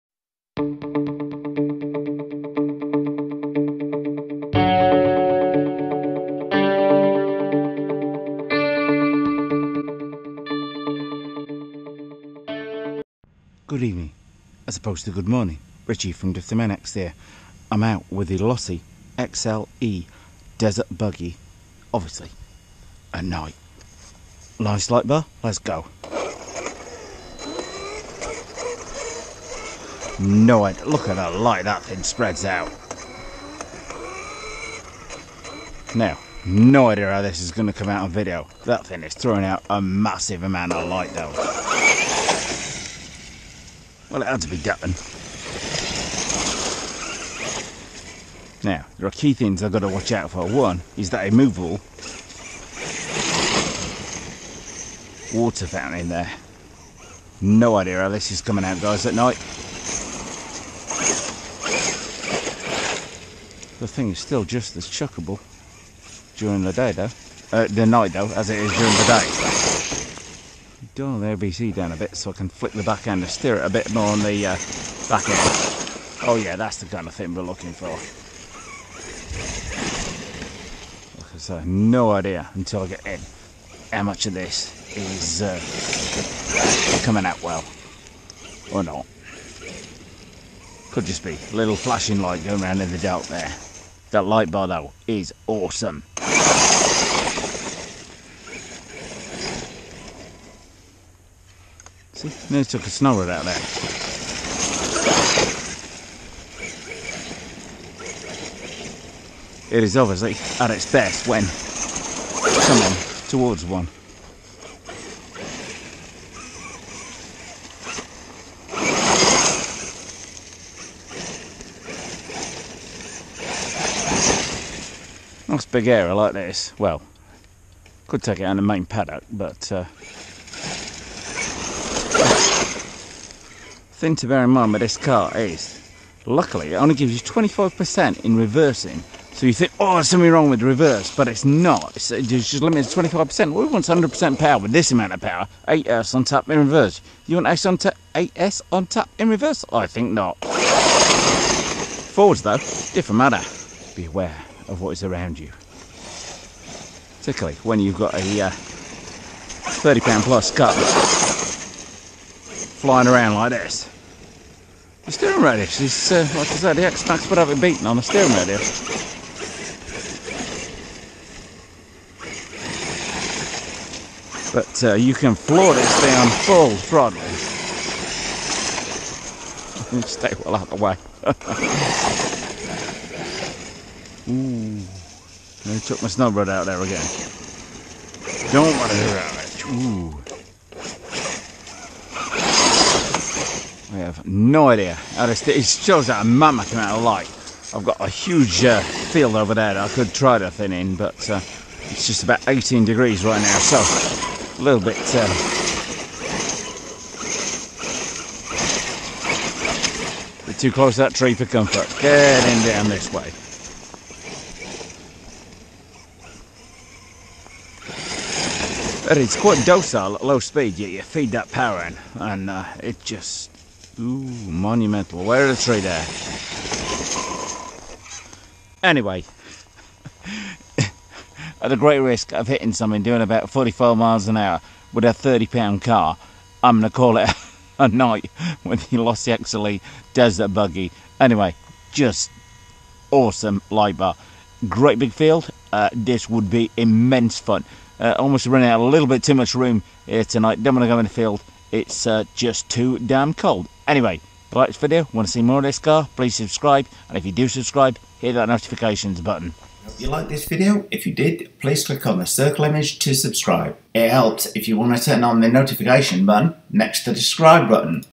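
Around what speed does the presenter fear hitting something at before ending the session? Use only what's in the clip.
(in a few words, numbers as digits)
45 miles an hour.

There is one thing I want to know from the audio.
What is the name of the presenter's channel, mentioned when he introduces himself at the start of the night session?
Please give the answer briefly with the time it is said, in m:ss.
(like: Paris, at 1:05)
Driftomaniacs, at 0:16.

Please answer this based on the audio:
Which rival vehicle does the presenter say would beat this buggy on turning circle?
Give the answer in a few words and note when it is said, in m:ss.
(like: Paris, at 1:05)
X-Maxx, at 2:46.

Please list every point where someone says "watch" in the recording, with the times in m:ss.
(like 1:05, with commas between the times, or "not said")
0:49.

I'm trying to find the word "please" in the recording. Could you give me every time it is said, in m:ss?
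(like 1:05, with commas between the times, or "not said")
4:16, 4:21.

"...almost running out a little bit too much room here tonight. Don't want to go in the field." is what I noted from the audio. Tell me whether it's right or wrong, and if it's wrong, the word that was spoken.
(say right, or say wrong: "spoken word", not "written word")
right.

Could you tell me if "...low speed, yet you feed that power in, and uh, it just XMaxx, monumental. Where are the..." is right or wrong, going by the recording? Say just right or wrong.
wrong.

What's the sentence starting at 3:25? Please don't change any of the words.
Uh, too close to that tree for comfort.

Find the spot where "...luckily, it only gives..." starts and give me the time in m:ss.
2:16.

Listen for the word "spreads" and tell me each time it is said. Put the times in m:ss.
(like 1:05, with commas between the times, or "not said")
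0:32.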